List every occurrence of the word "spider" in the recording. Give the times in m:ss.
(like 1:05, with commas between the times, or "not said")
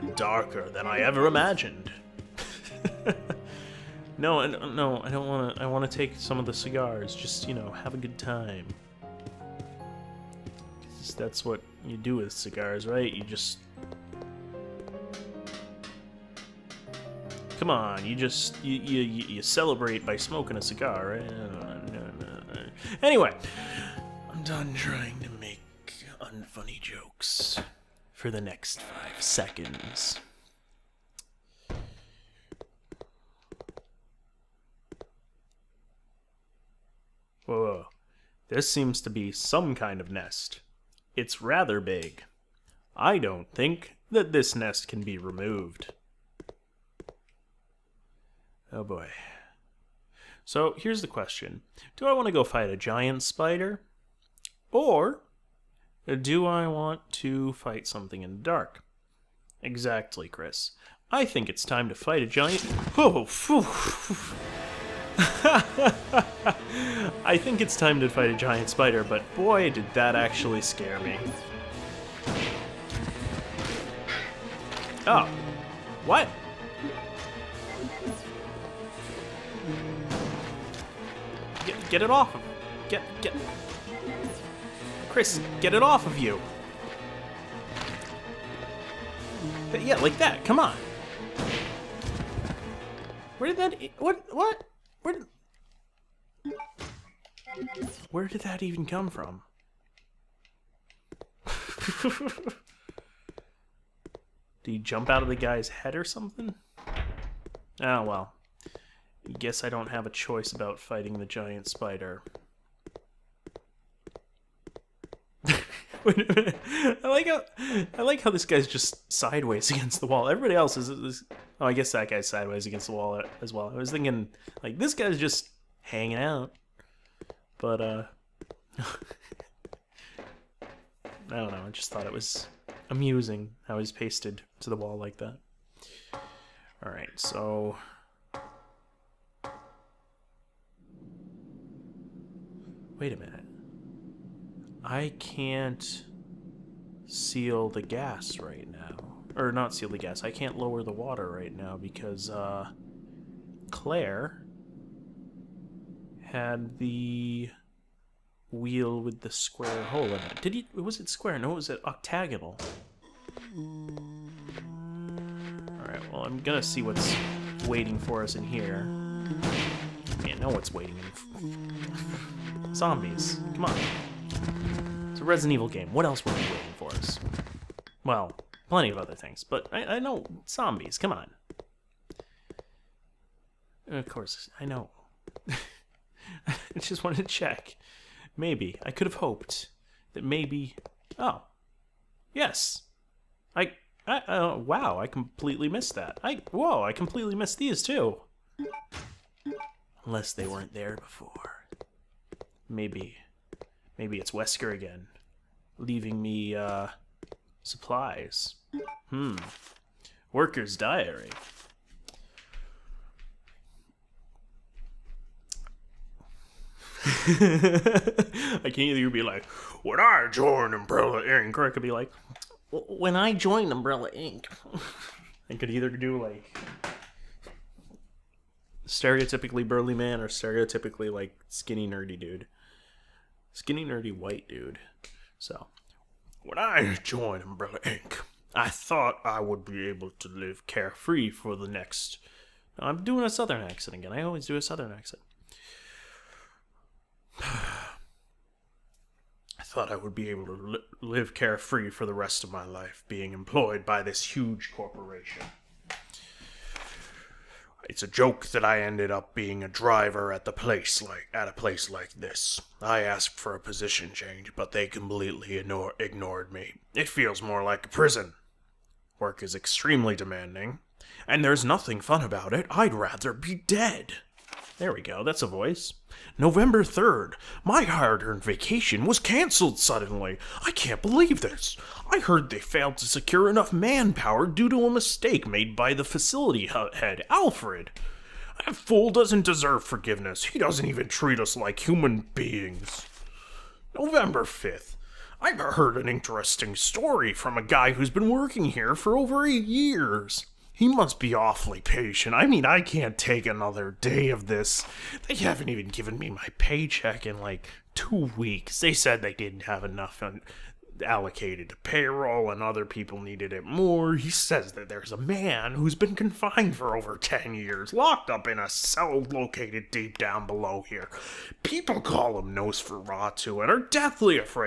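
0:53, 1:08, 1:51.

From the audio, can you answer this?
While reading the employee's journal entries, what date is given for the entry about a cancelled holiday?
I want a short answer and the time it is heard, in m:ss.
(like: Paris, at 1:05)
November 3rd, at 4:36.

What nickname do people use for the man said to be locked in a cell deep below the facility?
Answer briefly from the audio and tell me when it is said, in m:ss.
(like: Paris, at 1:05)
Nosferatu, at 5:22.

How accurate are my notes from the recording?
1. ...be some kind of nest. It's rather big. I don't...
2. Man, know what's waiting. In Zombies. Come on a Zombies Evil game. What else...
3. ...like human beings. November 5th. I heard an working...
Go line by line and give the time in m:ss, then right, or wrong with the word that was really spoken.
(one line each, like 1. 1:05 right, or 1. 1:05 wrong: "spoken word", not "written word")
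1. 0:39 right
2. 2:50 wrong: "Resident", not "Zombies"
3. 4:51 wrong: "interesting", not "working".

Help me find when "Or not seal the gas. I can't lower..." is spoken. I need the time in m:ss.
2:29.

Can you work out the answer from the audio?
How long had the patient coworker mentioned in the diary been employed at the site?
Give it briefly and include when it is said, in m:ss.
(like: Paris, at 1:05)
Over 8 years, at 4:59.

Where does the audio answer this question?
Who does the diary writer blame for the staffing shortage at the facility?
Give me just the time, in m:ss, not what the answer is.
4:47.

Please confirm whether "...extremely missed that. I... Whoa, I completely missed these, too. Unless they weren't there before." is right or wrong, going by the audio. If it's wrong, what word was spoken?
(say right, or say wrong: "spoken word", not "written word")
wrong: "completely", not "extremely".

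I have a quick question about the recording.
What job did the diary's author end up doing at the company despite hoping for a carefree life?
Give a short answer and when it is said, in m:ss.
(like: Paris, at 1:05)
Driver, at 4:19.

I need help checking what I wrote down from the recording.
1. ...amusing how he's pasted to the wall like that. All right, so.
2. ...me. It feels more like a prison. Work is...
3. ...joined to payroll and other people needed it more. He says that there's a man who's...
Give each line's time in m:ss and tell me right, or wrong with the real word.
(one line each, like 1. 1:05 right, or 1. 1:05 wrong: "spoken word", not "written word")
1. 2:12 right
2. 4:26 right
3. 5:11 wrong: "allocated", not "joined".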